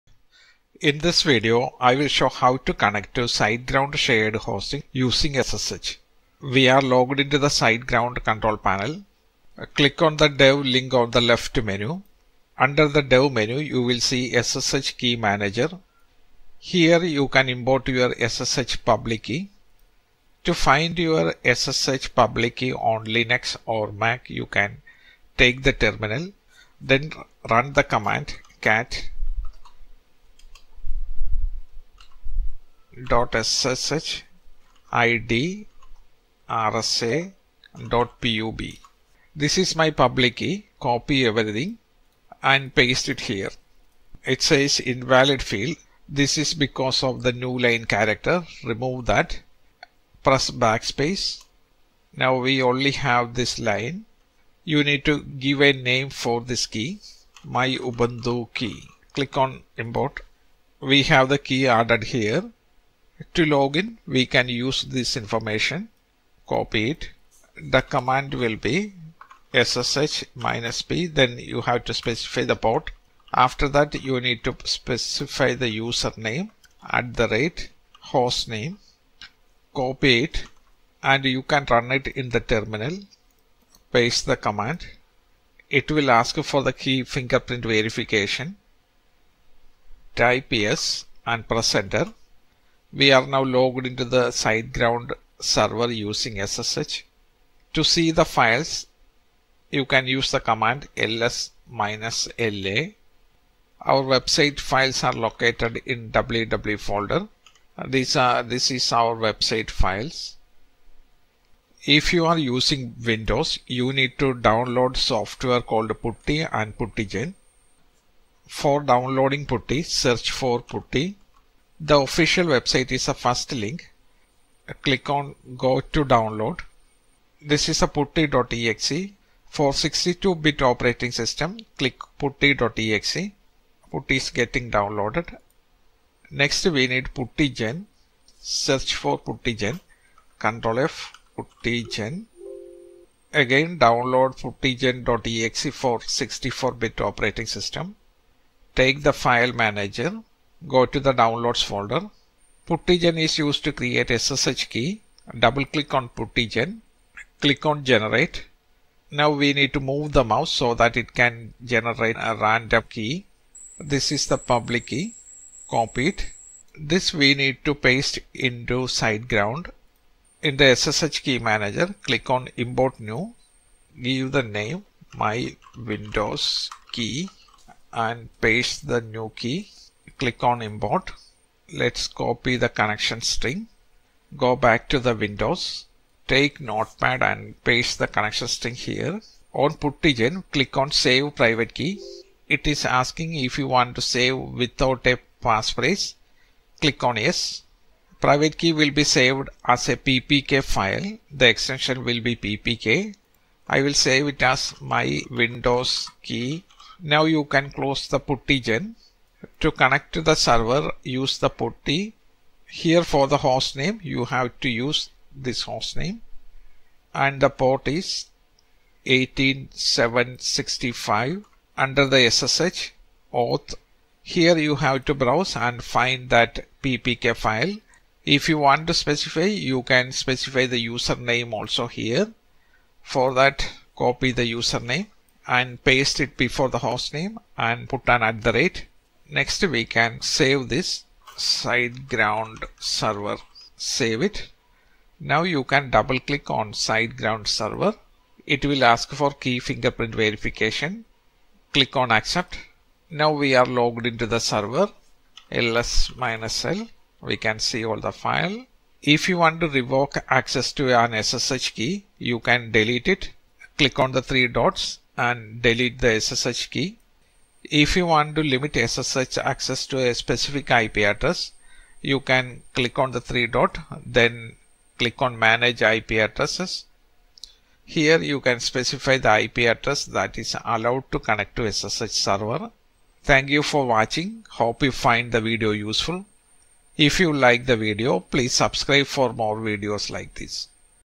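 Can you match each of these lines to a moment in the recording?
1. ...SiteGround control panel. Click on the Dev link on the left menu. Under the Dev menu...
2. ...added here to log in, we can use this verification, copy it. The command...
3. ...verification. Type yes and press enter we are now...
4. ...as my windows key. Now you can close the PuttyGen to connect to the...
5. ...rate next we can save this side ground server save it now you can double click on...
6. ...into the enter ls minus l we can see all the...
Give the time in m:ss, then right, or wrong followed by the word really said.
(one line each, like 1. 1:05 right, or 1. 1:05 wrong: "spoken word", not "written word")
1. 0:07 right
2. 1:01 wrong: "information", not "verification"
3. 1:27 right
4. 3:24 right
5. 3:58 right
6. 4:14 wrong: "server", not "enter".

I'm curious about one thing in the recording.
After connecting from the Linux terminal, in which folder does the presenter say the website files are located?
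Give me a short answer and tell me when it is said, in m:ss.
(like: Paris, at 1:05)
www, at 1:46.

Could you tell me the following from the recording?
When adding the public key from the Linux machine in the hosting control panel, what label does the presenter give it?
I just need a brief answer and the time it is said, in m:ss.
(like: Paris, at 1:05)
my ubuntu key, at 0:57.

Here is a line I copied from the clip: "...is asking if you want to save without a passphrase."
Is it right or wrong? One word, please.
right.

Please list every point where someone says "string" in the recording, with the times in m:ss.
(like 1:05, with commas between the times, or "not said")
3:03, 3:08.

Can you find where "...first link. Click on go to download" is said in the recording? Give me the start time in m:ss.
2:03.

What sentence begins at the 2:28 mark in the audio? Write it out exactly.
Take the file manager Go to the downloads folder.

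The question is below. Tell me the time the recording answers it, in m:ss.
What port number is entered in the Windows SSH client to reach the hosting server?
3:39.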